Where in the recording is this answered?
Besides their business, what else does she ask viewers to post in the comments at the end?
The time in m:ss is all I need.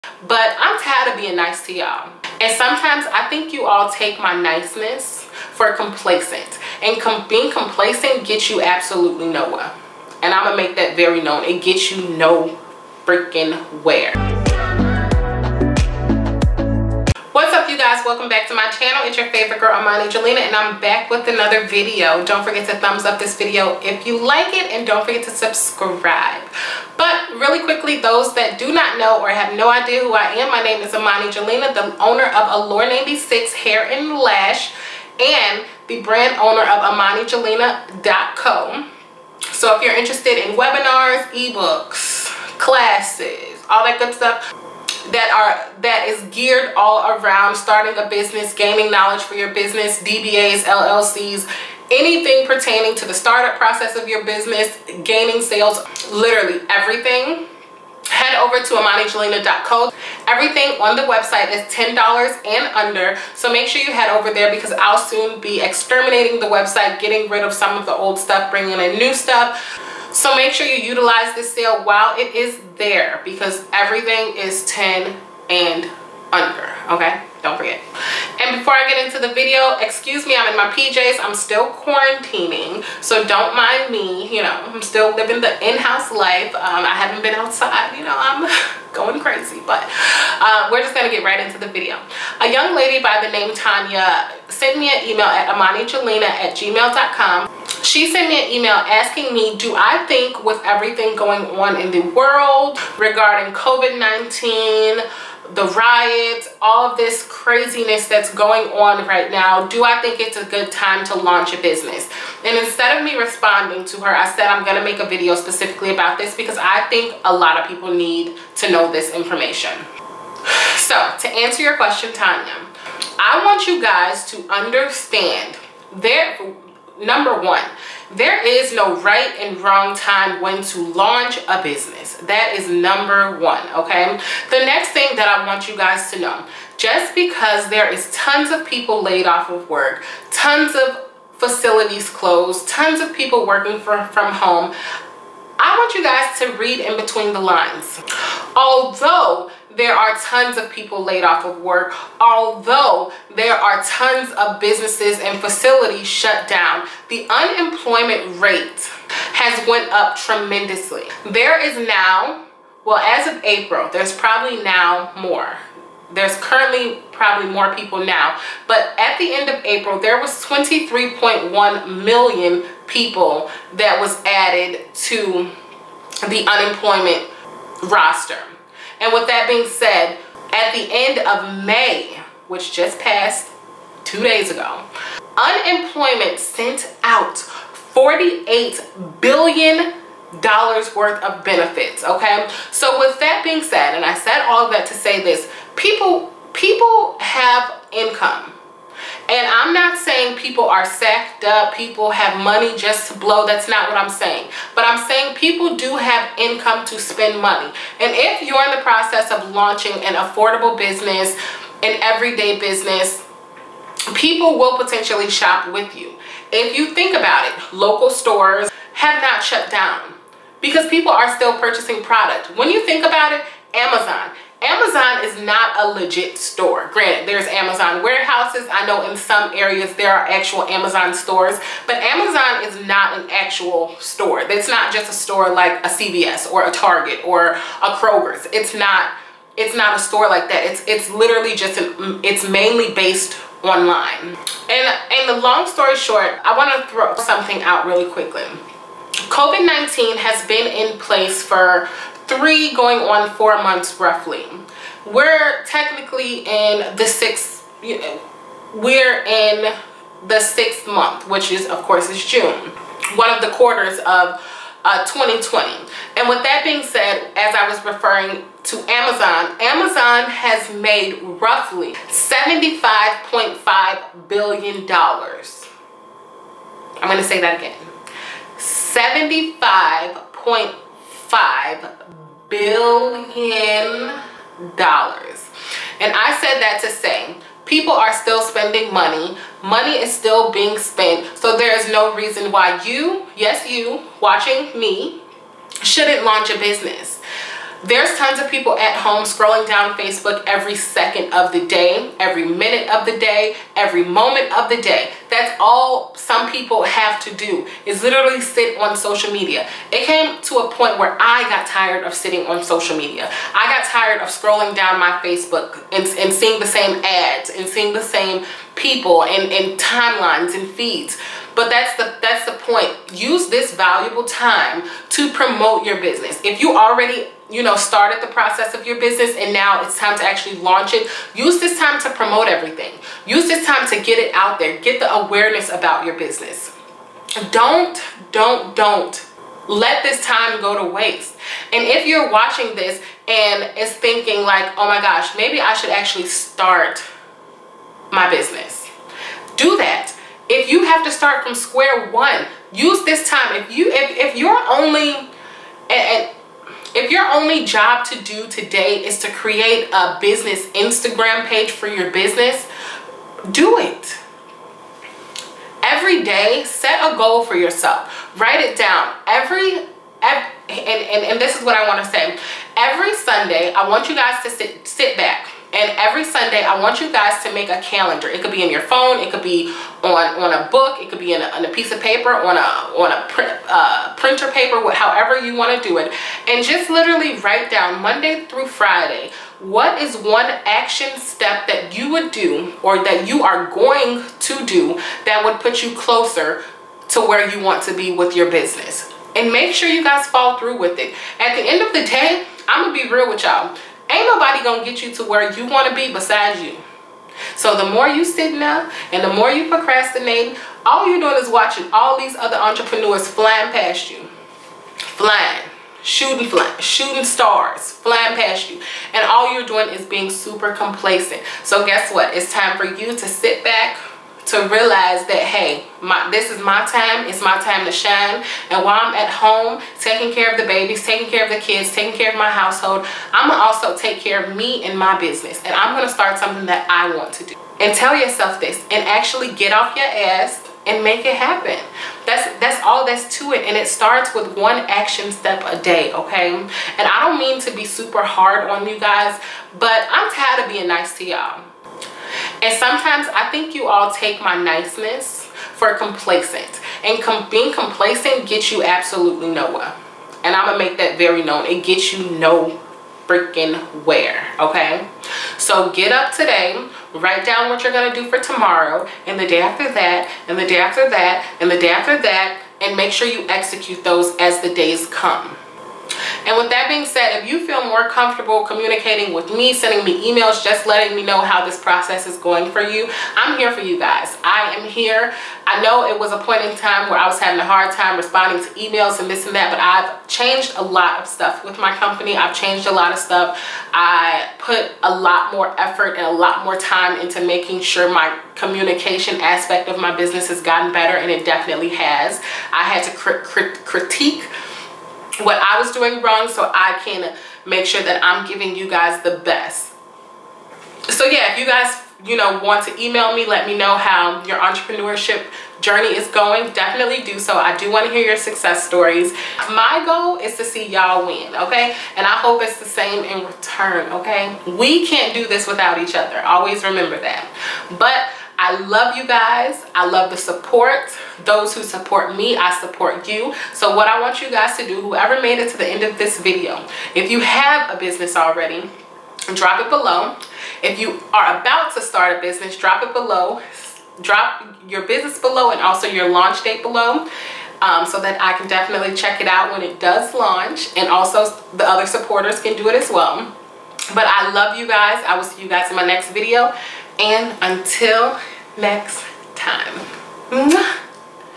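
9:06.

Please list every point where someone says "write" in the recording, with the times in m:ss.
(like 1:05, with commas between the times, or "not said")
6:08, 6:27, 7:47.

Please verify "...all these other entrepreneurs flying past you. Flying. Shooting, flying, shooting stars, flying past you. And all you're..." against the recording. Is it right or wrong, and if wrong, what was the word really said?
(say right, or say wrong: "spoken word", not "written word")
right.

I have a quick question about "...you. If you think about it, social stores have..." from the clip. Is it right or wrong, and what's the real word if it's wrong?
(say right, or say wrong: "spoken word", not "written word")
wrong: "local", not "social".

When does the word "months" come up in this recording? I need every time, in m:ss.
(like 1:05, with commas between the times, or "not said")
4:13, 4:20.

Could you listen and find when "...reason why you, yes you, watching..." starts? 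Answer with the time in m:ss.
4:52.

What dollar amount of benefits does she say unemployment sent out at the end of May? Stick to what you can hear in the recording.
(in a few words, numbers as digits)
48 billion dollars.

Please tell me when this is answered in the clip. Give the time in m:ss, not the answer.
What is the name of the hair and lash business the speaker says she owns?
0:32.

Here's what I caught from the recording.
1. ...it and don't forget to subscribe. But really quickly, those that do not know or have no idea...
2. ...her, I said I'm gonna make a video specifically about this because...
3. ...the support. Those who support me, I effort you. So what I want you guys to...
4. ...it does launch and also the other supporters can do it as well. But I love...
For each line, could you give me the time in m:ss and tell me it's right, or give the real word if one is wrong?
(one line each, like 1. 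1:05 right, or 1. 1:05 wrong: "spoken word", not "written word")
1. 0:24 right
2. 1:54 right
3. 8:50 wrong: "support", not "effort"
4. 9:09 right.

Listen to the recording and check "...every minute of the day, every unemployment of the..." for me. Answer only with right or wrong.
wrong.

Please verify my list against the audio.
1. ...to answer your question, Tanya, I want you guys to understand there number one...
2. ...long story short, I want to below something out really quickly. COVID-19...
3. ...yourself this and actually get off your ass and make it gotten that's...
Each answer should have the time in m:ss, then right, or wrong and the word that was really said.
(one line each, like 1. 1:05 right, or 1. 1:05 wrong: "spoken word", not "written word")
1. 2:01 right
2. 4:05 wrong: "throw", not "below"
3. 7:18 wrong: "happen", not "gotten".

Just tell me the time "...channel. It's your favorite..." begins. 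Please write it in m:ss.
0:18.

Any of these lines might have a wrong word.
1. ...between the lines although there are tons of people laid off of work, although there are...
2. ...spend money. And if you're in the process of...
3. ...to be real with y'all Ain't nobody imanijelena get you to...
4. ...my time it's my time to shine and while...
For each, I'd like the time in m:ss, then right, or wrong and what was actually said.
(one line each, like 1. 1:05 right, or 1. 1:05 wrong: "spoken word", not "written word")
1. 2:26 right
2. 3:26 right
3. 6:42 wrong: "gonna", not "imanijelena"
4. 7:06 right.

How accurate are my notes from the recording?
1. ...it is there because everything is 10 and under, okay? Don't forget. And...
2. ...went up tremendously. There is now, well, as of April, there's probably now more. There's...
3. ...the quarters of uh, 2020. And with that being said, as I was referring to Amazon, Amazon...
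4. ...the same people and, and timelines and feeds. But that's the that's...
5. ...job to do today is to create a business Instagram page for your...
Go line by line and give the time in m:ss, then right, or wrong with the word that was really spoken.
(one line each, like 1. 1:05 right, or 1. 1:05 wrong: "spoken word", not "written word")
1. 1:12 right
2. 2:39 right
3. 4:23 right
4. 5:17 right
5. 5:57 right.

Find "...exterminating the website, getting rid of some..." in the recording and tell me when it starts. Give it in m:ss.
1:05.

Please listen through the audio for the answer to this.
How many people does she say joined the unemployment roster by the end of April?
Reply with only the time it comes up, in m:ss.
2:50.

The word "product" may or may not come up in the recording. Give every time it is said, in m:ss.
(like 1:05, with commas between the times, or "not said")
3:42.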